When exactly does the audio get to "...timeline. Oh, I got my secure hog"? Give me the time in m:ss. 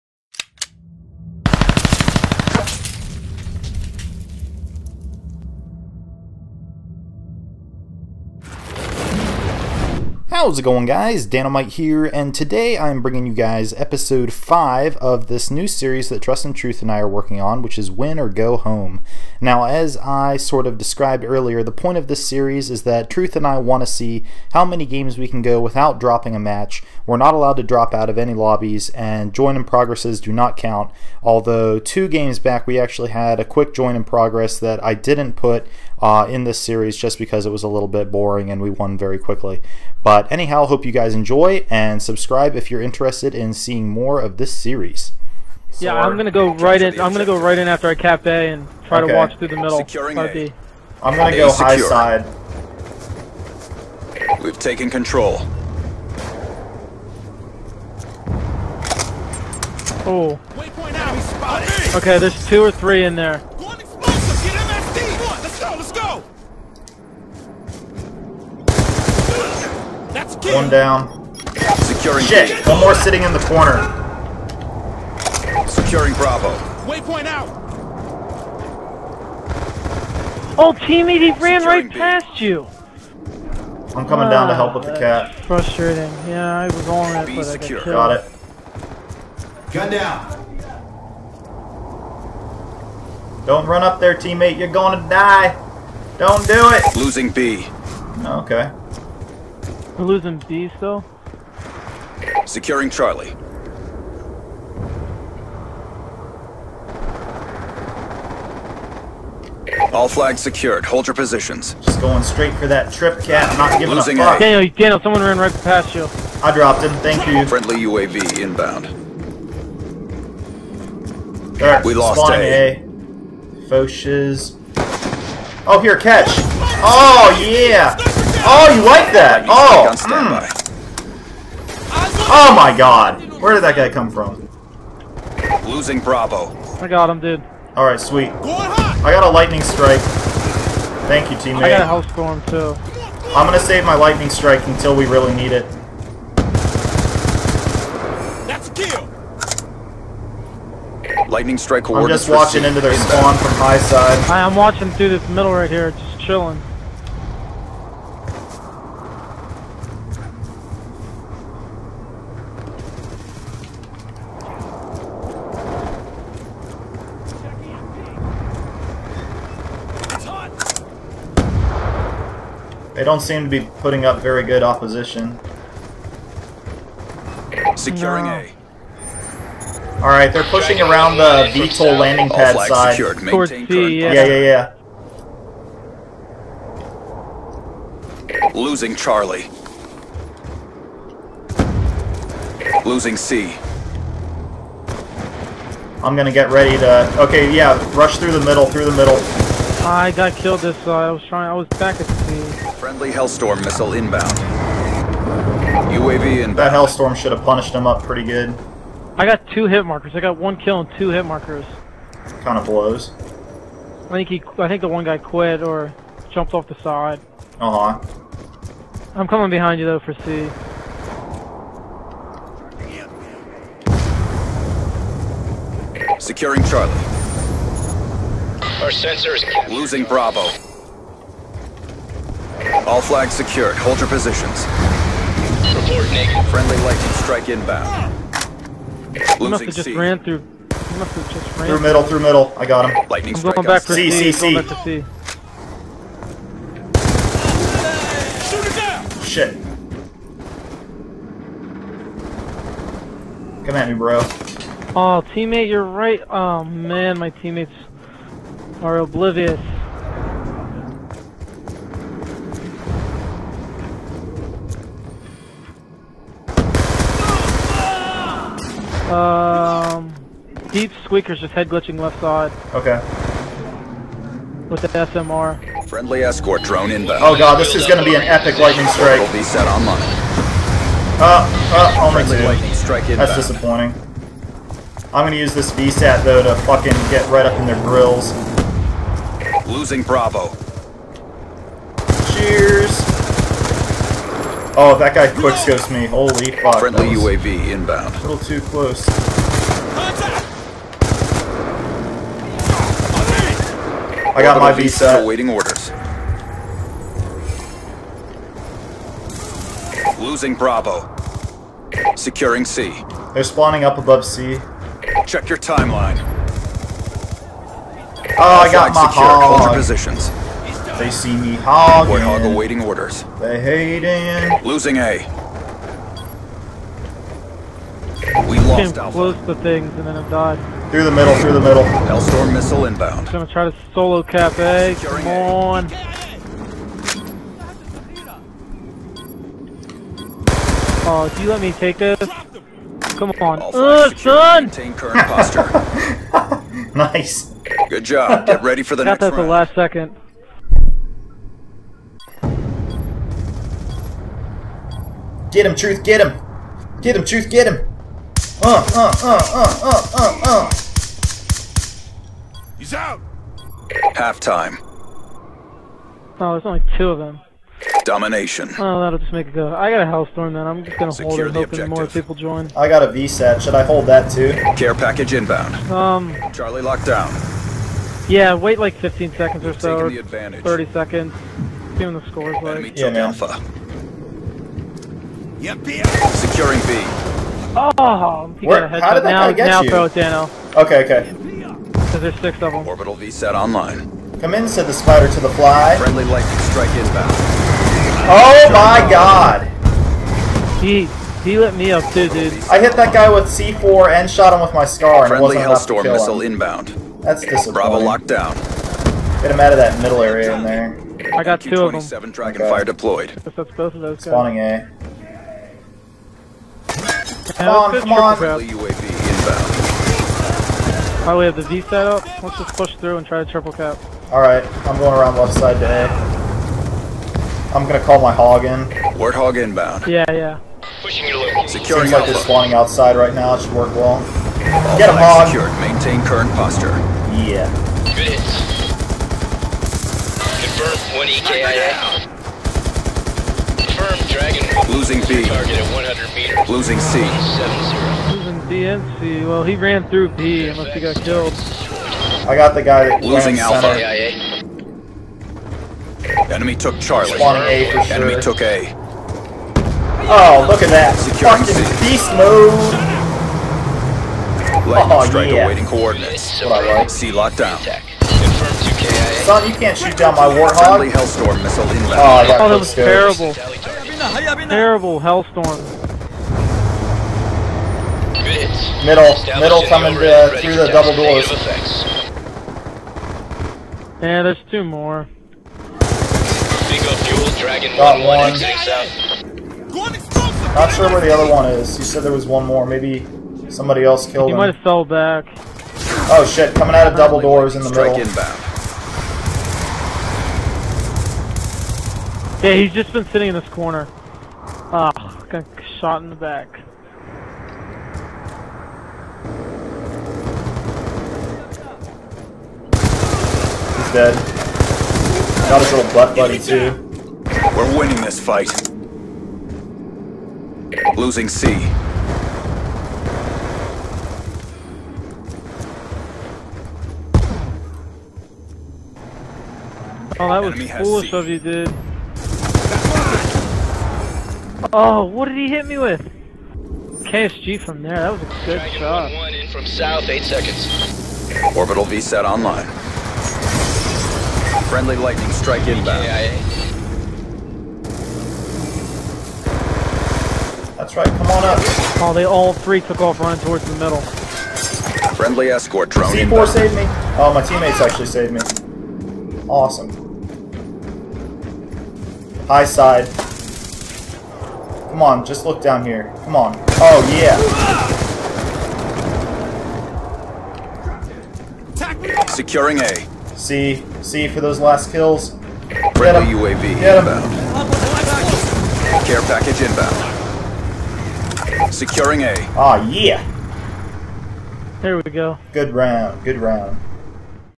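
5:15.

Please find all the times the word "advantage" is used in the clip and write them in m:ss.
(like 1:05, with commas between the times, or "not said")
6:20.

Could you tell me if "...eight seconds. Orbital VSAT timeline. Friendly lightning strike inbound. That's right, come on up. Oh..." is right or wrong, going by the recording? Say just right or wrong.
wrong.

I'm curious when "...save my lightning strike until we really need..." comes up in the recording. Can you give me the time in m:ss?
2:23.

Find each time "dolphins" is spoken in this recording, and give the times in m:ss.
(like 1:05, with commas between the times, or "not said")
not said.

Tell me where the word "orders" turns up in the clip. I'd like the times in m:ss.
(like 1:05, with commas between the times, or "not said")
5:05, 5:22.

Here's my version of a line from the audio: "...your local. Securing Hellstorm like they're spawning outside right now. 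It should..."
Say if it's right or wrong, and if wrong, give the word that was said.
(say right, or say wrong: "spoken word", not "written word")
wrong: "Seems", not "Hellstorm".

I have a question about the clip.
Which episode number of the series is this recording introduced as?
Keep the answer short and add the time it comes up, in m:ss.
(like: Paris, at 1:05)
5, at 0:13.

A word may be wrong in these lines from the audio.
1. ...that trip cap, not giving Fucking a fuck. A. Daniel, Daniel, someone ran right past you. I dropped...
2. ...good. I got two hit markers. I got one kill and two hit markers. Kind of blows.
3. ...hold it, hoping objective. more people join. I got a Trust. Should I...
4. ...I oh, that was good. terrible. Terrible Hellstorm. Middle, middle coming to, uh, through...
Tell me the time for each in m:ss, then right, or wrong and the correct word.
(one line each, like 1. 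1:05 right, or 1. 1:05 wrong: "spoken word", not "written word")
1. 1:52 wrong: "Losing", not "Fucking"
2. 3:28 right
3. 6:11 wrong: "VSAT", not "Trust"
4. 7:52 right.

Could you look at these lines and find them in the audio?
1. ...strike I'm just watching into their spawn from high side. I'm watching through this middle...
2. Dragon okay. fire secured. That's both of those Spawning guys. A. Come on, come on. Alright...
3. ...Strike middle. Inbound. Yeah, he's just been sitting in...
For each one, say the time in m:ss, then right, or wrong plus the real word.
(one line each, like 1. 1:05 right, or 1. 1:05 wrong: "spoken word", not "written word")
1. 2:31 right
2. 6:52 wrong: "deployed", not "secured"
3. 8:17 right.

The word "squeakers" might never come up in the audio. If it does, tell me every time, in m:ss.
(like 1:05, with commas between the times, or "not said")
4:31.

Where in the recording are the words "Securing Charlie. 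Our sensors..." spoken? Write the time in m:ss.
3:46.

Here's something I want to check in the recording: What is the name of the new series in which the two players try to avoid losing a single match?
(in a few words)
Win or Go Home.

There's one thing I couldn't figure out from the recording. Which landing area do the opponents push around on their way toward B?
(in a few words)
VTOL landing pad.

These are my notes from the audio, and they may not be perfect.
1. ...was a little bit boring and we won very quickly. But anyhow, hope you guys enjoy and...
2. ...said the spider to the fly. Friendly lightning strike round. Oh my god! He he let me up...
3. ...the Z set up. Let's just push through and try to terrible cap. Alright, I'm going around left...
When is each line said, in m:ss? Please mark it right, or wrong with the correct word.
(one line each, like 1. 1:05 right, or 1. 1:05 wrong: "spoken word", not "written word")
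1. 0:37 right
2. 6:34 wrong: "inbound", not "round"
3. 7:01 wrong: "triple", not "terrible".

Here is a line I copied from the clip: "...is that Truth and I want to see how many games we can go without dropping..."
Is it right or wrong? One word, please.
right.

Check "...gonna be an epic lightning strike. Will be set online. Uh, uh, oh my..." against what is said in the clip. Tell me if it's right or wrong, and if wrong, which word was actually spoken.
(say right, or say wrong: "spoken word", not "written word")
right.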